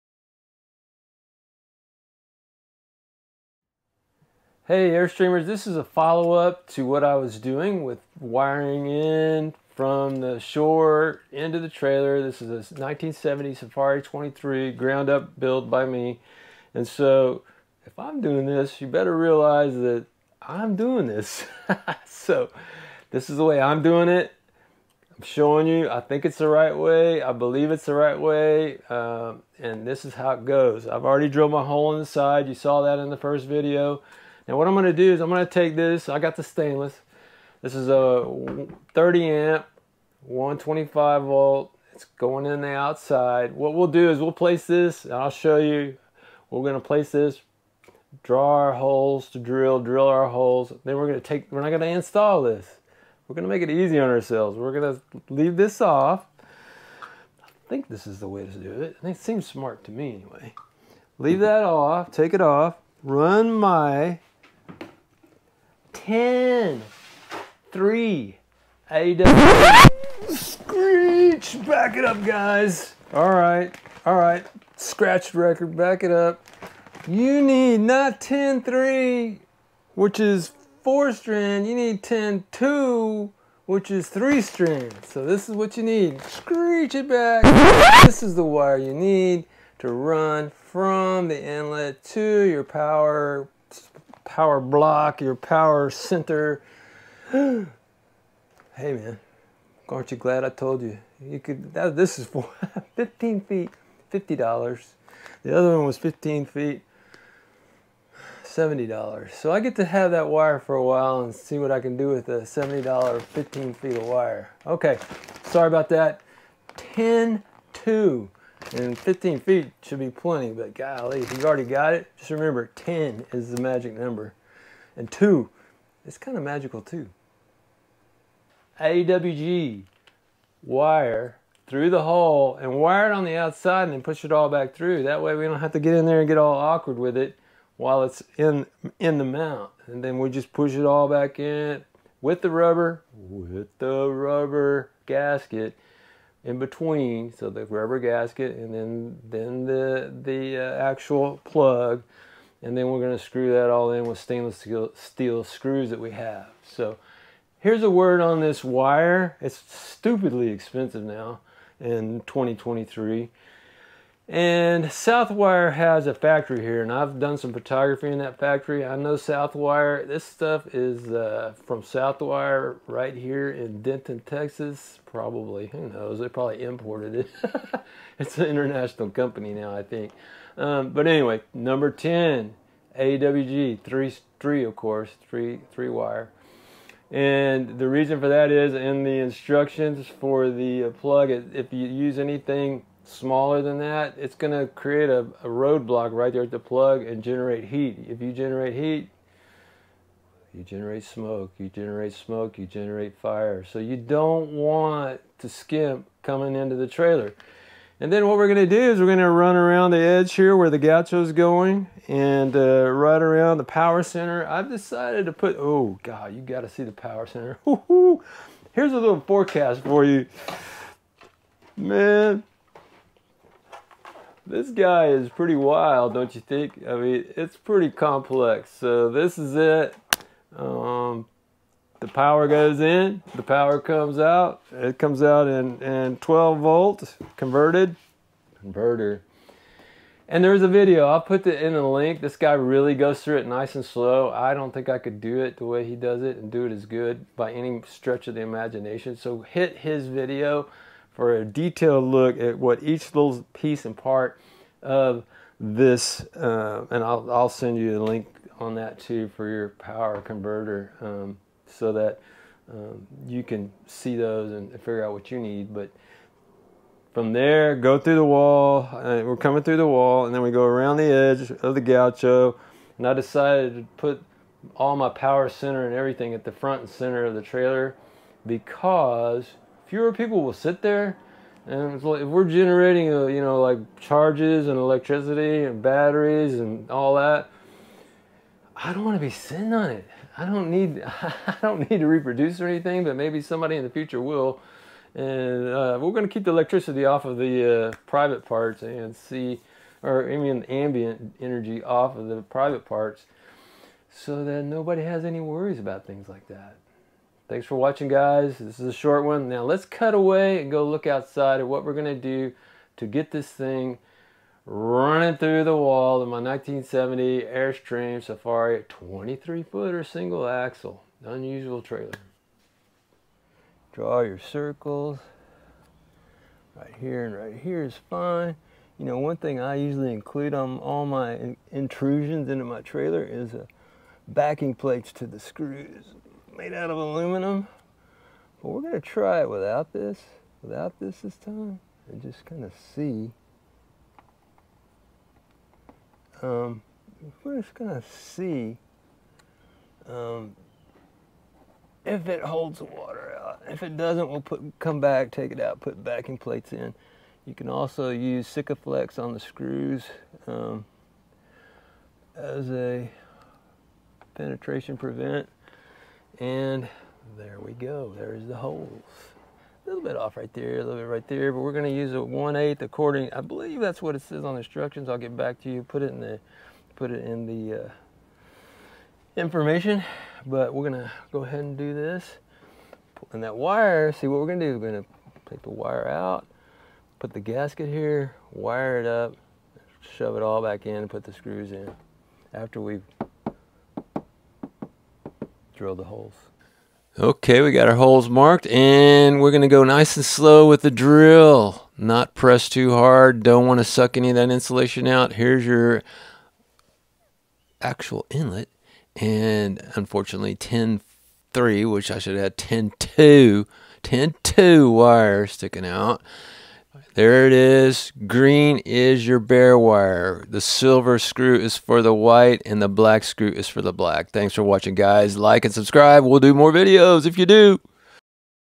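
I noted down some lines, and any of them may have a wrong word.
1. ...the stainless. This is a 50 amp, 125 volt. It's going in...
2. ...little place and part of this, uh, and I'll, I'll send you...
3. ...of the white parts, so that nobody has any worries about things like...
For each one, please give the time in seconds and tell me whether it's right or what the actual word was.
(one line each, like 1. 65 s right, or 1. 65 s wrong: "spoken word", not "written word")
1. 36 s wrong: "30", not "50"
2. 253 s wrong: "piece", not "place"
3. 302 s wrong: "private", not "white".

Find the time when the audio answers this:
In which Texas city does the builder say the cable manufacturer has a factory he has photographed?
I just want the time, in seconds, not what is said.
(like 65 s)
173 s.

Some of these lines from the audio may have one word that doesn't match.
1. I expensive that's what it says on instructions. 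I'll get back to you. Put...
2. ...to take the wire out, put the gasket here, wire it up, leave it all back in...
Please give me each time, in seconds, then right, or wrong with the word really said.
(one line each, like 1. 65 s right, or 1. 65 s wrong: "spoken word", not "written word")
1. 373 s wrong: "believe", not "expensive"
2. 385 s wrong: "shove", not "leave".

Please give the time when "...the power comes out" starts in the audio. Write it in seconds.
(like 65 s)
233 s.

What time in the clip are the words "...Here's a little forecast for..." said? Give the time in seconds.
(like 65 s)
218 s.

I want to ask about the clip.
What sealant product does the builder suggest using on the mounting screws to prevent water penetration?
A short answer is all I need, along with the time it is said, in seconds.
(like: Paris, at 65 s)
Sikaflex, at 358 s.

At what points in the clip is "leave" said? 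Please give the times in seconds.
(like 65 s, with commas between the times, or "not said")
55 s, 61 s.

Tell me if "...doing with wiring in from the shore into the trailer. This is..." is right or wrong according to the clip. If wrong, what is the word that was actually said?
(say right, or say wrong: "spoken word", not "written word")
right.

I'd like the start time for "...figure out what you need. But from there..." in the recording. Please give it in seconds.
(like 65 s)
264 s.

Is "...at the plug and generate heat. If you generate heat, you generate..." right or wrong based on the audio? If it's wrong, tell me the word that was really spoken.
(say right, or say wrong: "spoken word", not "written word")
right.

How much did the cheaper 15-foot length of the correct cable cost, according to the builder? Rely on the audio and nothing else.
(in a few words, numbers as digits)
$50.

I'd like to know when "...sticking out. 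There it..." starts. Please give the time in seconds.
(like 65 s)
415 s.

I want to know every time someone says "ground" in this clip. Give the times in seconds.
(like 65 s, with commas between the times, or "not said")
14 s.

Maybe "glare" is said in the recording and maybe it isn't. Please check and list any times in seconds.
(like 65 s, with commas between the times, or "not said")
not said.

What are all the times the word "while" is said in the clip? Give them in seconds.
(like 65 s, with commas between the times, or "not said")
110 s, 137 s.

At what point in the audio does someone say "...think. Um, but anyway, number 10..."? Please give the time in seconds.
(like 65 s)
179 s.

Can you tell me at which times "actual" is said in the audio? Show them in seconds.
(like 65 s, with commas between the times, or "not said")
150 s, 407 s.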